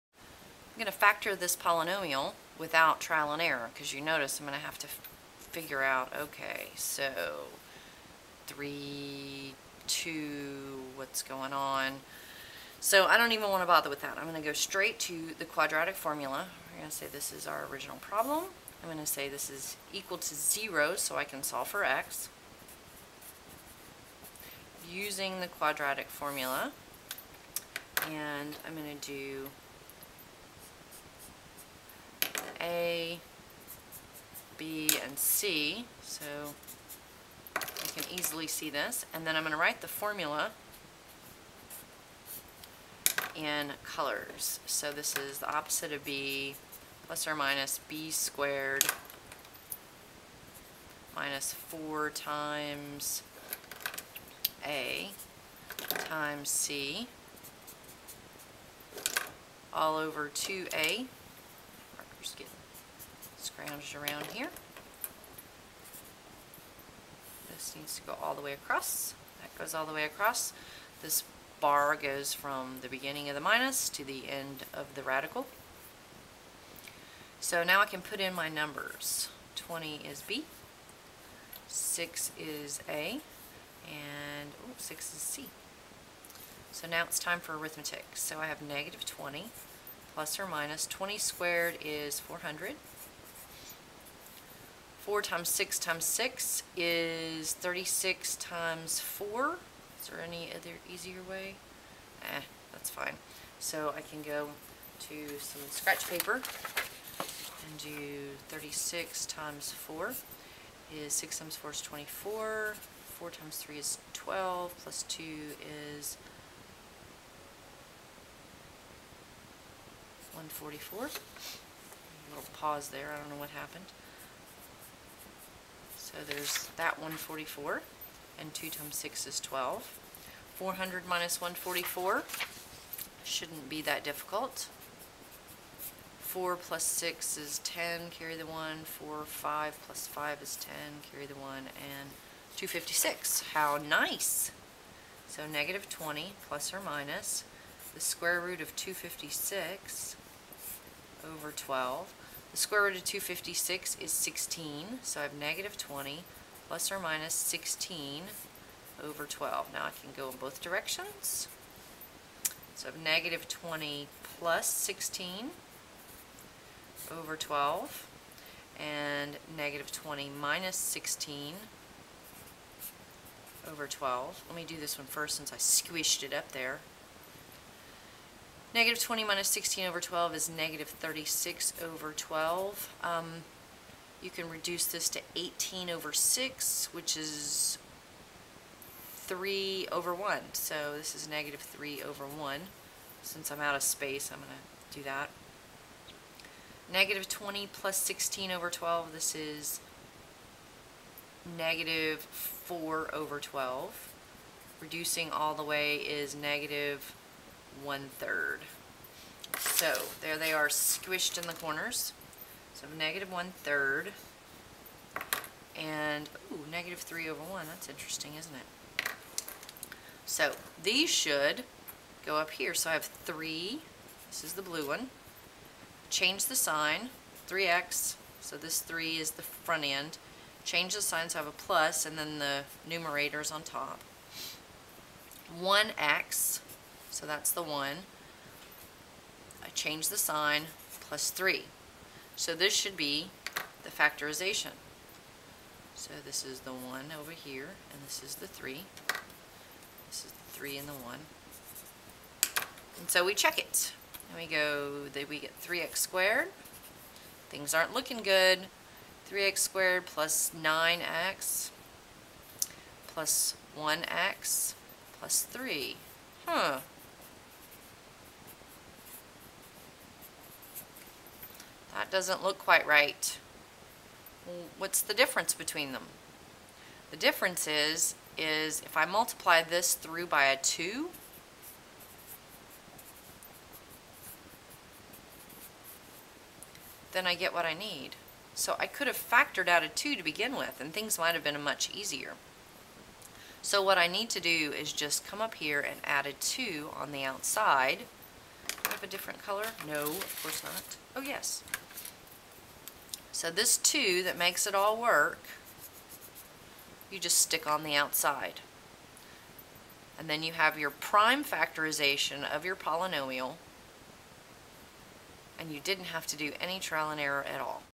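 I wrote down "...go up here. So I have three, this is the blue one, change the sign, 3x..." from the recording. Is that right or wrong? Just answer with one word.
right.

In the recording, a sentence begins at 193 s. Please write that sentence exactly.
Since I'm out of space, I'm going to do that.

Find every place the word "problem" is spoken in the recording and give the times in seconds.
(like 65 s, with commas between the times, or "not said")
17 s.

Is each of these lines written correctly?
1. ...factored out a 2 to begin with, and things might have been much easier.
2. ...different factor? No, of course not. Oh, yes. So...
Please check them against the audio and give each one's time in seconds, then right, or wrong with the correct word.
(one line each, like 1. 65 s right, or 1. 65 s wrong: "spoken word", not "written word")
1. 289 s right
2. 299 s wrong: "color", not "factor".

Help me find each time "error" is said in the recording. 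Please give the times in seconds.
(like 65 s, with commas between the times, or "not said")
3 s, 317 s.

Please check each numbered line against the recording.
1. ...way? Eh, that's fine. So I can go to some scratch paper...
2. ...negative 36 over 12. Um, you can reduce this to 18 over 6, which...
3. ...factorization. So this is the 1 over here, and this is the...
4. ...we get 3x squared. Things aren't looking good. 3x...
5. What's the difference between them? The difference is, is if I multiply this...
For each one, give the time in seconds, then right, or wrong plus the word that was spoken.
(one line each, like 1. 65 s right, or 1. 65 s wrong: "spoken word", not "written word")
1. 101 s right
2. 180 s right
3. 243 s right
4. 255 s right
5. 274 s right.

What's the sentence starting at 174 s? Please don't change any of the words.
Let me do this one first since I squished it up there.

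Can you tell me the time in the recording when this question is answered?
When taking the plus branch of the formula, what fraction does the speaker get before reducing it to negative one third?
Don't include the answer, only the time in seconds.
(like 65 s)
201 s.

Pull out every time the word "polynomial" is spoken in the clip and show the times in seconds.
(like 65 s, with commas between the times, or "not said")
1 s, 312 s.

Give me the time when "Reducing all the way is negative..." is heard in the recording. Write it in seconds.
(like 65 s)
204 s.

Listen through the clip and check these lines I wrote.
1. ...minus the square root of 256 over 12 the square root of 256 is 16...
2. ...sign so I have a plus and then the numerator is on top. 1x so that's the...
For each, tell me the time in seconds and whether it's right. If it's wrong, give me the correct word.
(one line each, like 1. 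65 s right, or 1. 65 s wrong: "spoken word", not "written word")
1. 146 s right
2. 231 s right.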